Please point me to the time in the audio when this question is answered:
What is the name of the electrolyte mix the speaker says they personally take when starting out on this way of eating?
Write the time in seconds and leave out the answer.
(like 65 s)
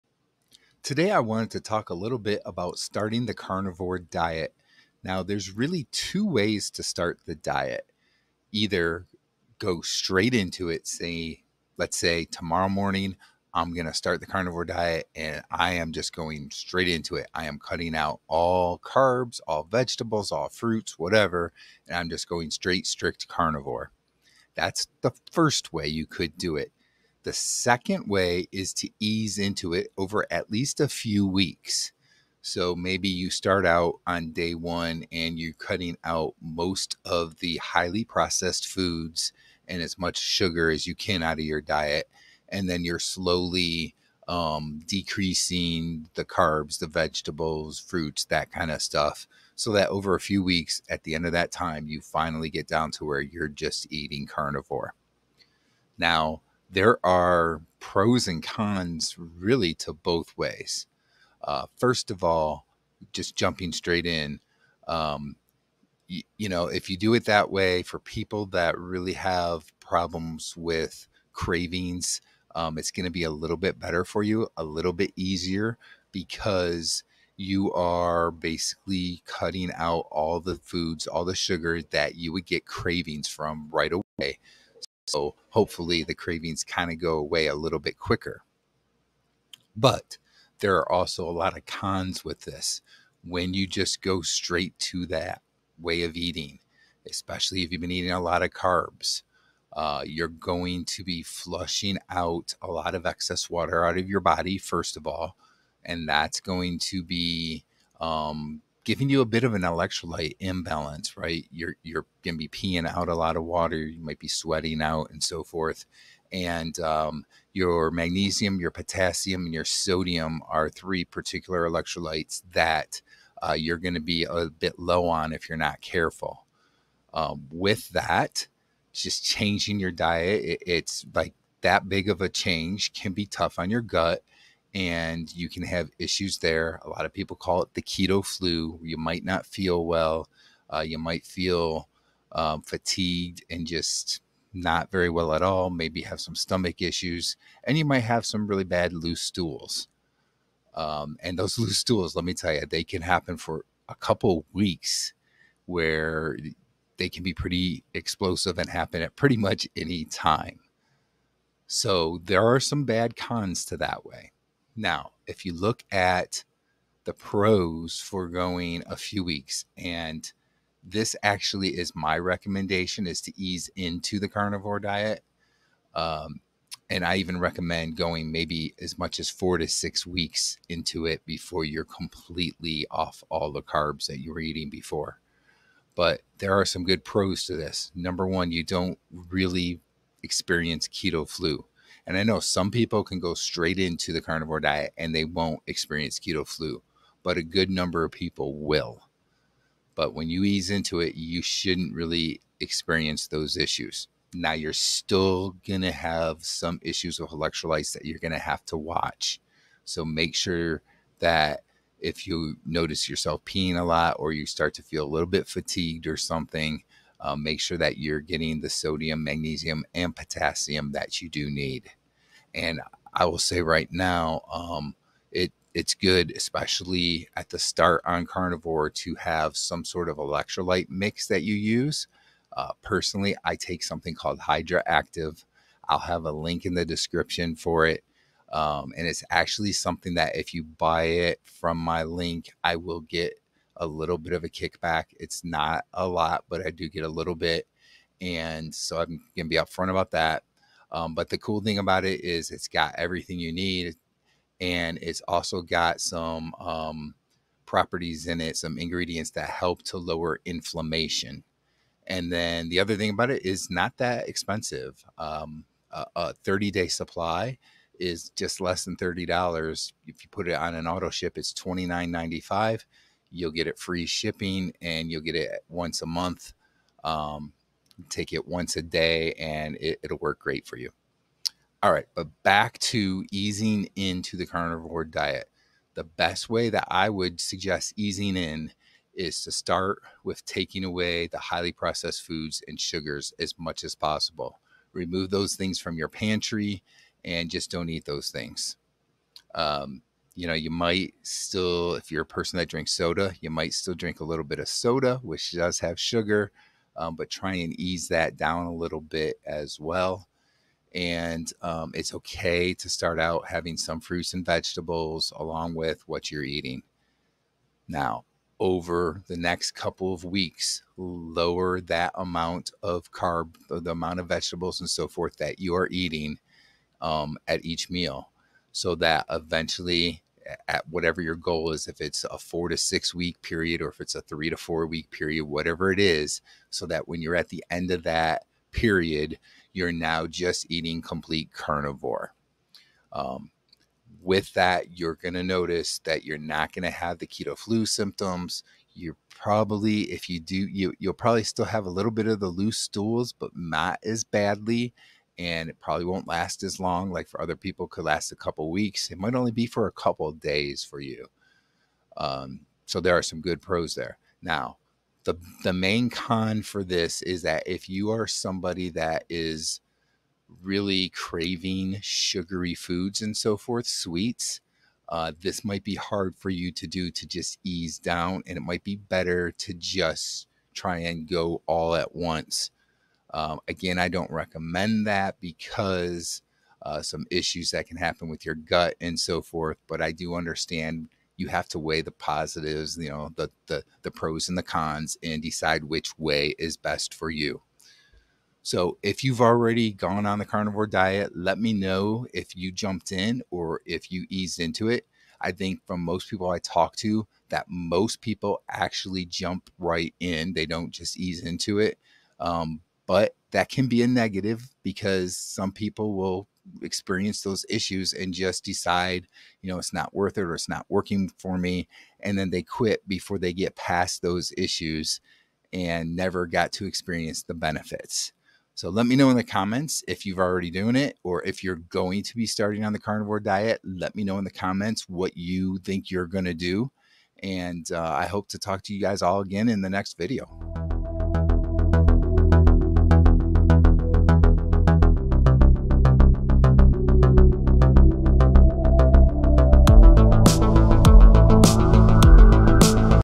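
234 s.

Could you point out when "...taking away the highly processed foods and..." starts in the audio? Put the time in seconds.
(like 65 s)
290 s.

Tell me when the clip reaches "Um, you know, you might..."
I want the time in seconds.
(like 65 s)
299 s.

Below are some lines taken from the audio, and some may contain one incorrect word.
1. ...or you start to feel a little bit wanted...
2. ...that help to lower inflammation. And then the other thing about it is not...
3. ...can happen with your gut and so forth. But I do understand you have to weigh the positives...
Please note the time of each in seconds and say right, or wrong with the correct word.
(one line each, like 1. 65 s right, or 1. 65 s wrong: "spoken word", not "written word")
1. 214 s wrong: "fatigued", not "wanted"
2. 259 s right
3. 387 s right.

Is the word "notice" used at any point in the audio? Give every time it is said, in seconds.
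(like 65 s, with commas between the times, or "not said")
212 s, 345 s.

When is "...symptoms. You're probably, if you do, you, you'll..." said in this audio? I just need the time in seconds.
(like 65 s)
347 s.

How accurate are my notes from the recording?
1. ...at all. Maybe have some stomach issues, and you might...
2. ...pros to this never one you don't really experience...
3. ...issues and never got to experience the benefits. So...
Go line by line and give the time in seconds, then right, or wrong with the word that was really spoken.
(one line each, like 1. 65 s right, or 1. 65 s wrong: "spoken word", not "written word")
1. 145 s right
2. 187 s wrong: "number", not "never"
3. 424 s right.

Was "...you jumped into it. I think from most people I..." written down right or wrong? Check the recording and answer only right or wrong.
wrong.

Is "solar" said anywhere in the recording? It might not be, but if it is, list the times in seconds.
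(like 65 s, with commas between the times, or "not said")
not said.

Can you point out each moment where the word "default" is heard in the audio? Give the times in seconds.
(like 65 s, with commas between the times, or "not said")
not said.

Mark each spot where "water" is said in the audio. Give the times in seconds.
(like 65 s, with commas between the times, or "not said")
103 s, 113 s.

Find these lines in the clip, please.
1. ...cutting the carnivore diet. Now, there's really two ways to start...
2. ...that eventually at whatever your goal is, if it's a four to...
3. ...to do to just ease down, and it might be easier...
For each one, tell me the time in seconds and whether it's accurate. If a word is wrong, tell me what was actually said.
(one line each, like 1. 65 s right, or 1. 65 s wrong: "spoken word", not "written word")
1. 2 s wrong: "starting", not "cutting"
2. 328 s right
3. 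376 s wrong: "better", not "easier".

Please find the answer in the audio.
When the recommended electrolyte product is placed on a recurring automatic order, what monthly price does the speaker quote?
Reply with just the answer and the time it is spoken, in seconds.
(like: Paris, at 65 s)
$29.95, at 271 s.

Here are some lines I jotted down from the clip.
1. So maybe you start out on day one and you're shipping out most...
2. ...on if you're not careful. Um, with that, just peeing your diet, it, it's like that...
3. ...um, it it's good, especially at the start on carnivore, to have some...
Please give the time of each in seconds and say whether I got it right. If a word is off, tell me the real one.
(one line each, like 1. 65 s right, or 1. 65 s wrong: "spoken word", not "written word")
1. 32 s wrong: "cutting", not "shipping"
2. 125 s wrong: "changing", not "peeing"
3. 224 s right.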